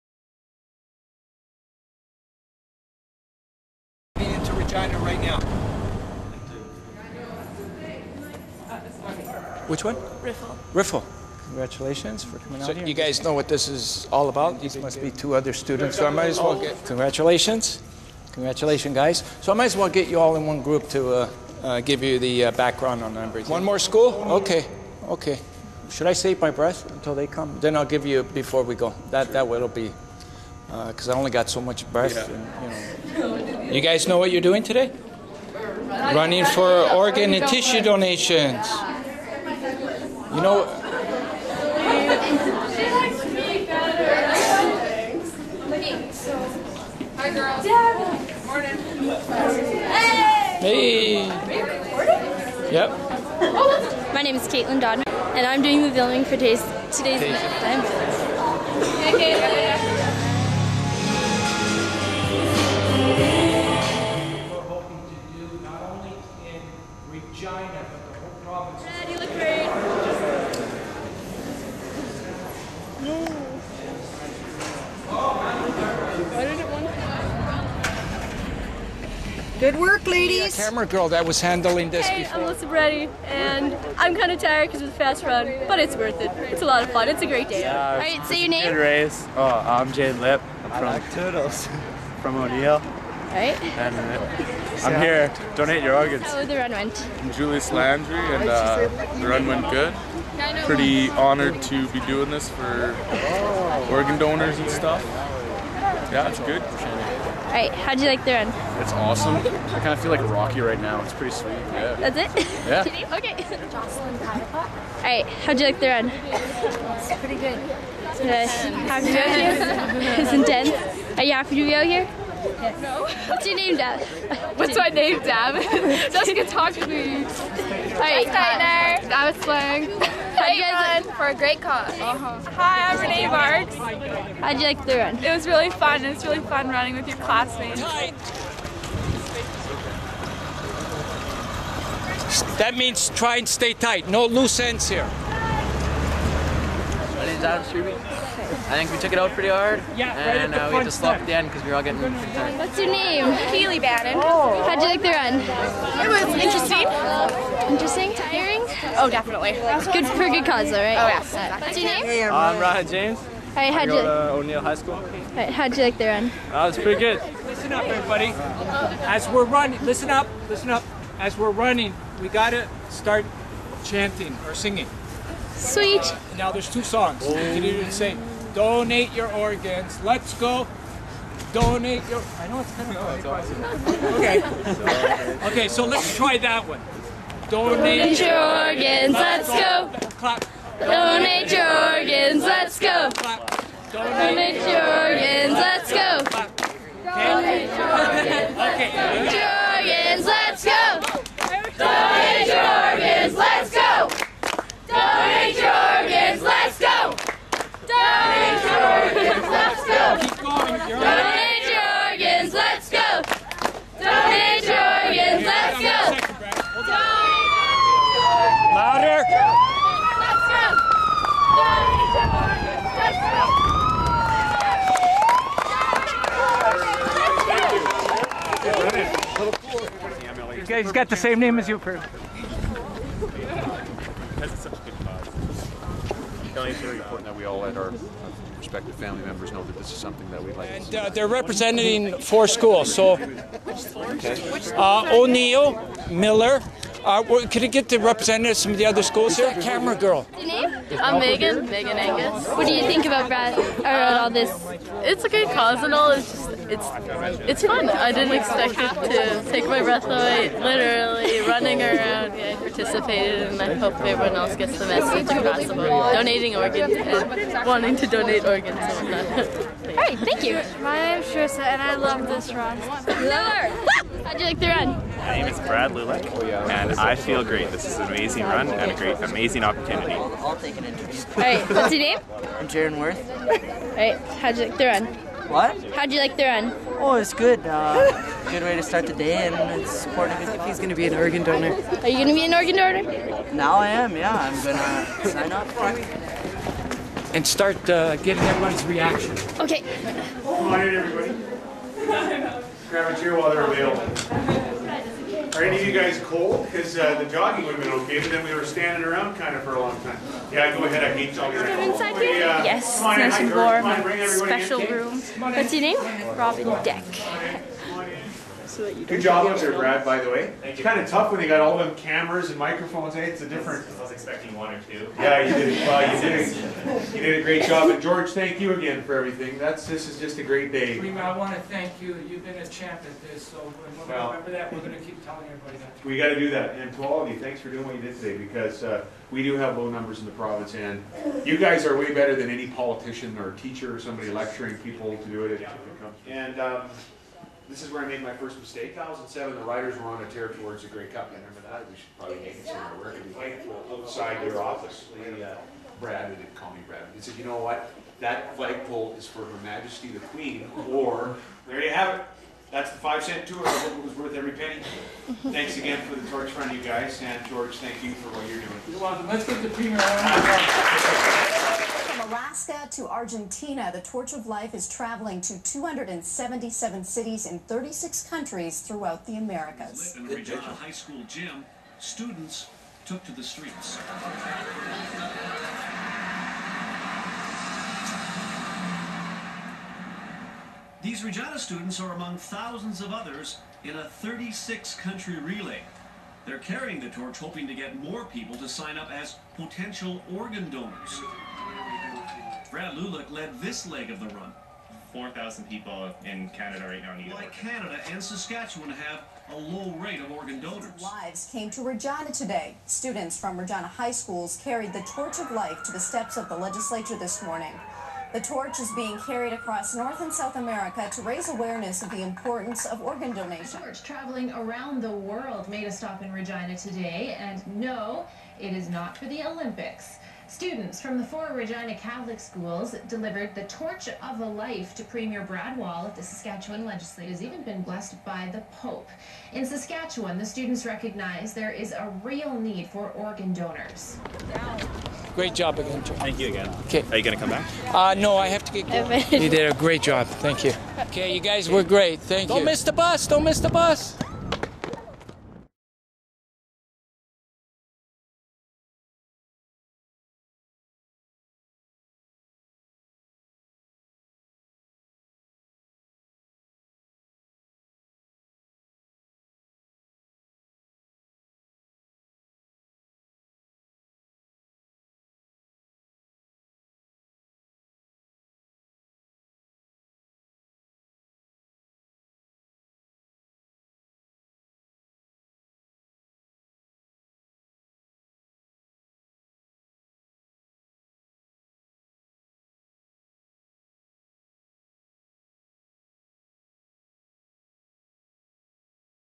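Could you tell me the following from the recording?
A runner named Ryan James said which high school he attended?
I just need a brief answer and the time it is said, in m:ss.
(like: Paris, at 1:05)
O'Neill High School, at 2:44.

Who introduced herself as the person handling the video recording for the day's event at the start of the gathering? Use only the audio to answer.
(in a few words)
Caitlin Dodd.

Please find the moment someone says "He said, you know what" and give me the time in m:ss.
5:57.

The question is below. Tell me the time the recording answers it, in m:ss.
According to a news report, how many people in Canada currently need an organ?
6:45.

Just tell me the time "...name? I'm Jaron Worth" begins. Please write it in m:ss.
4:42.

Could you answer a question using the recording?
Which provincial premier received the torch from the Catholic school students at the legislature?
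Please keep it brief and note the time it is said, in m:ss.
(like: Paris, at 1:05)
Brad Wall, at 7:15.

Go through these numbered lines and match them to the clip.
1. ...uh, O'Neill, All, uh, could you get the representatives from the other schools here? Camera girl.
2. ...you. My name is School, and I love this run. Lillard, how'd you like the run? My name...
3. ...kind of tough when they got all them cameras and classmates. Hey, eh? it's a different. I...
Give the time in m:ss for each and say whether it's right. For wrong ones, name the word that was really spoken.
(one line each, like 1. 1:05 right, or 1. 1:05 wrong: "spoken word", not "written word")
1. 4:04 wrong: "Miller", not "All"
2. 4:30 wrong: "Trissa", not "School"
3. 5:20 wrong: "microphones", not "classmates".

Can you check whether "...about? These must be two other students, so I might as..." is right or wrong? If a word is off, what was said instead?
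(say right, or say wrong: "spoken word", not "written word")
right.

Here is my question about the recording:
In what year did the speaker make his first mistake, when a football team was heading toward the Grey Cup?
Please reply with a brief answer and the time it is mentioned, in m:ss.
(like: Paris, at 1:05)
2007, at 5:48.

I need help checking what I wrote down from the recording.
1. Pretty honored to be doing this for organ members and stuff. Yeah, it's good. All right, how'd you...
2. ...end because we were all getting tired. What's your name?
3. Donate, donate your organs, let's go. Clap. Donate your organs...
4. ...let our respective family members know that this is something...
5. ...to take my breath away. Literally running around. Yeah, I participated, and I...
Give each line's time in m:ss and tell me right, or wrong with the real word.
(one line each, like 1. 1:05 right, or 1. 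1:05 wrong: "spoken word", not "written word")
1. 1:40 wrong: "donors", not "members"
2. 2:31 right
3. 3:07 right
4. 3:57 right
5. 4:19 right.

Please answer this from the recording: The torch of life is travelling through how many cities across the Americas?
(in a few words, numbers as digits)
277.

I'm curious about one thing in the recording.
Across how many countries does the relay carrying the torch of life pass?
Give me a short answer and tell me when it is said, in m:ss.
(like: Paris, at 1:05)
36, at 6:17.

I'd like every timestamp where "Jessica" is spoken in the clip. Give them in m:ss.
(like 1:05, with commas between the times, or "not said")
2:06.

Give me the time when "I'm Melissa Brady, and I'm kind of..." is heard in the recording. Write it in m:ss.
1:22.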